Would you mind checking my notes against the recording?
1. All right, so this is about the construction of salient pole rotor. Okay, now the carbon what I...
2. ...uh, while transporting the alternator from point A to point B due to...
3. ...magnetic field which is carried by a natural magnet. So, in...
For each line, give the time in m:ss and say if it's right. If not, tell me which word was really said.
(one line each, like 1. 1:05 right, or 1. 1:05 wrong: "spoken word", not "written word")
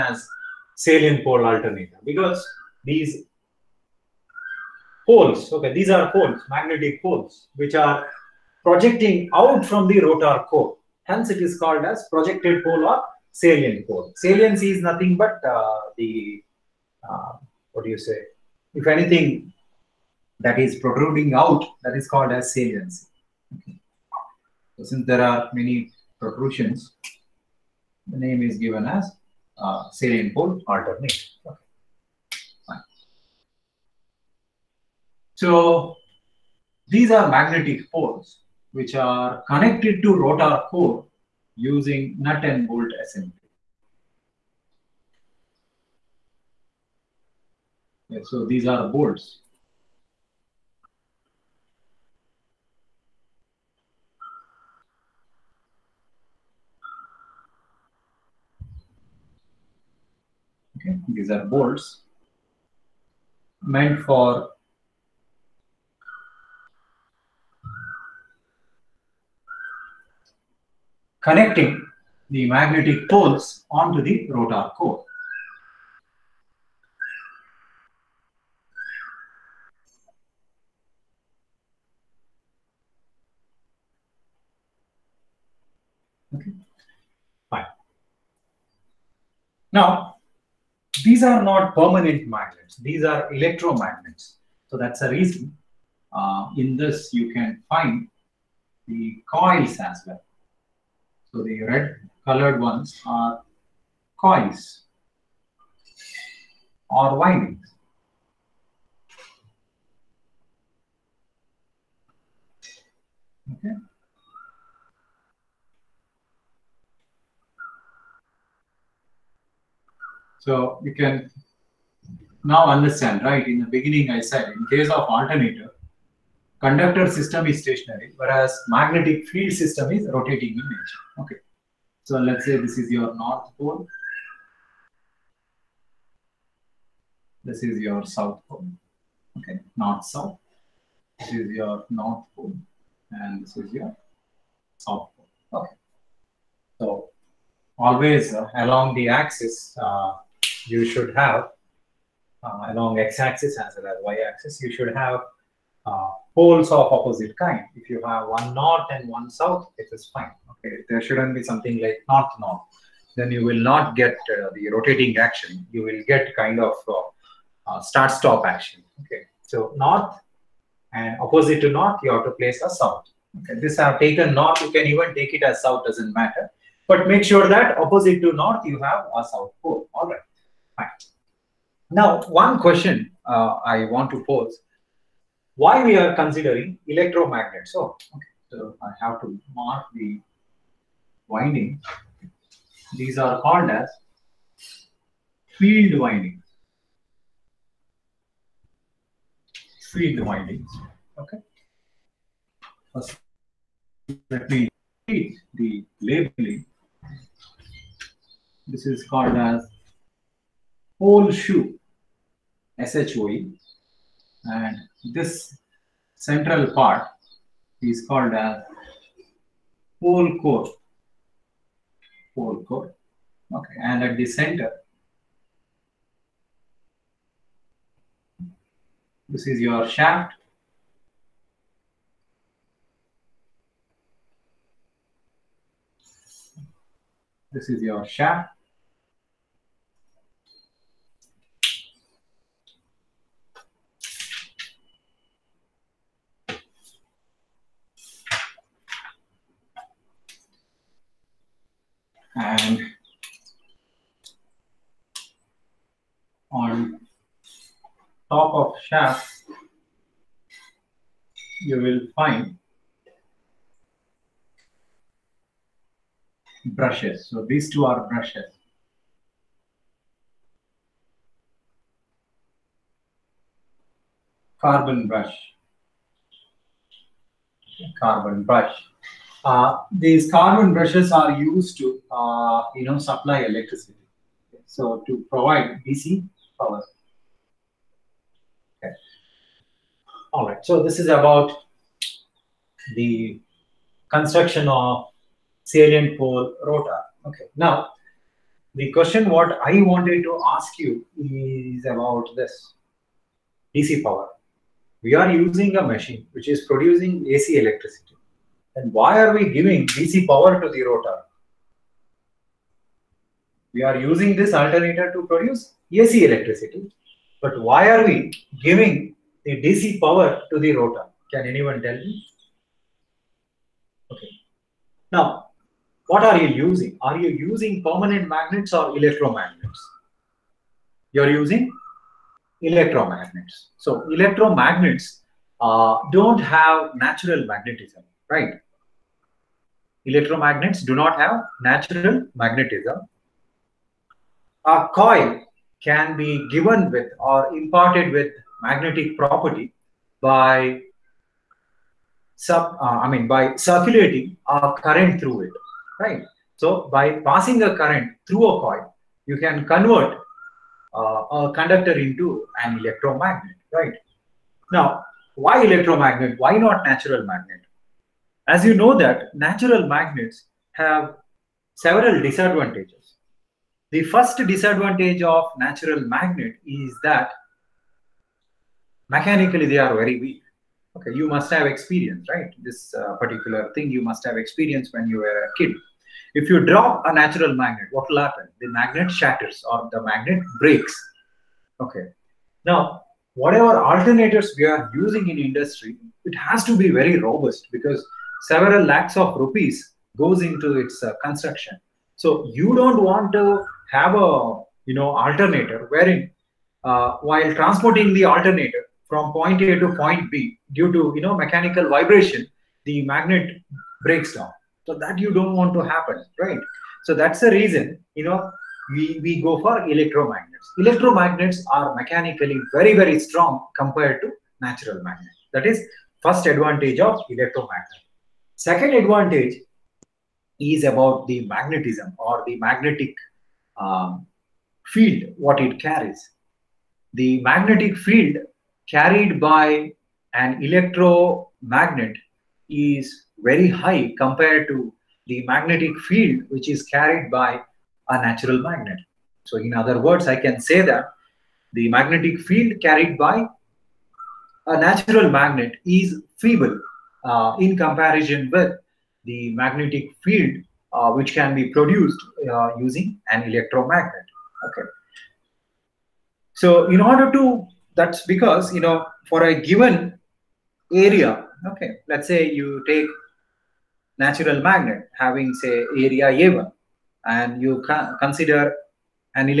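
1. 4:50 wrong: "question", not "carbon"
2. 6:46 right
3. 7:25 right.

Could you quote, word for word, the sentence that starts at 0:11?
Hence, it is called as projected pole or salient pole.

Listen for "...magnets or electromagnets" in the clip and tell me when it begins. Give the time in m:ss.
5:28.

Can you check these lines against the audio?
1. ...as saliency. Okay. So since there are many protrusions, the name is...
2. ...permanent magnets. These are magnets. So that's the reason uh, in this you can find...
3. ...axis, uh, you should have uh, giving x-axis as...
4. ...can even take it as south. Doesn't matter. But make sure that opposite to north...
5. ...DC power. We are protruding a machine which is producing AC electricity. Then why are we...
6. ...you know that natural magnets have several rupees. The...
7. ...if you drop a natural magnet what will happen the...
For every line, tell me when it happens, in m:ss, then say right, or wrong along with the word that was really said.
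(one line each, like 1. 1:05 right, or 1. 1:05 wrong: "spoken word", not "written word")
1. 0:22 right
2. 1:31 wrong: "electromagnets", not "magnets"
3. 2:29 wrong: "along", not "giving"
4. 2:54 right
5. 5:03 wrong: "using", not "protruding"
6. 6:08 wrong: "disadvantages", not "rupees"
7. 6:26 right.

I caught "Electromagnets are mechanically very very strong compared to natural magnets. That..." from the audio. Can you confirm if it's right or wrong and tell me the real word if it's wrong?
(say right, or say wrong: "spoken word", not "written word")
right.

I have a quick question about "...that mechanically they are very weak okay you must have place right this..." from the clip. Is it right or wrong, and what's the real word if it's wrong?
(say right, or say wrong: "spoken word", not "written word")
wrong: "experience", not "place".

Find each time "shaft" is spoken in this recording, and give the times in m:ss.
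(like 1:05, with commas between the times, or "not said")
3:49, 3:58, 4:18.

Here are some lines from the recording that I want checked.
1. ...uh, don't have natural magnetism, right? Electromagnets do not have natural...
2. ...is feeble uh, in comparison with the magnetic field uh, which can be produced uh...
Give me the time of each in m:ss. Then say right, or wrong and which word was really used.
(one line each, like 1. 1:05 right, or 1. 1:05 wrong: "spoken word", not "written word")
1. 5:35 right
2. 7:35 right.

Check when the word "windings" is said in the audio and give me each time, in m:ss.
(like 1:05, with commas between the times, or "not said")
1:47, 3:11, 3:15, 3:20.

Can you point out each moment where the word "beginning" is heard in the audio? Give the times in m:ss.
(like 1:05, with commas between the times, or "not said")
2:03.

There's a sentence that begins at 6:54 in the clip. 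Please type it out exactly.
So that you don't want to happen, right?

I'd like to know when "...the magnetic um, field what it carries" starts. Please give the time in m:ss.
7:12.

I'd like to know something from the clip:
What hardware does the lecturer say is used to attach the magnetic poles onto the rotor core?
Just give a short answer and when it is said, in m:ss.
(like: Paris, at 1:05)
Nut and bolt assembly, at 0:42.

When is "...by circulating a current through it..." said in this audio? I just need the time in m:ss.
5:53.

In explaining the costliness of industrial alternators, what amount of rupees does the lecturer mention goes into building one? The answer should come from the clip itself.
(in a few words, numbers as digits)
Several lakhs.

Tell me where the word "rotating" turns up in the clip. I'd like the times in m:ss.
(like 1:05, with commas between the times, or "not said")
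2:10, 2:44.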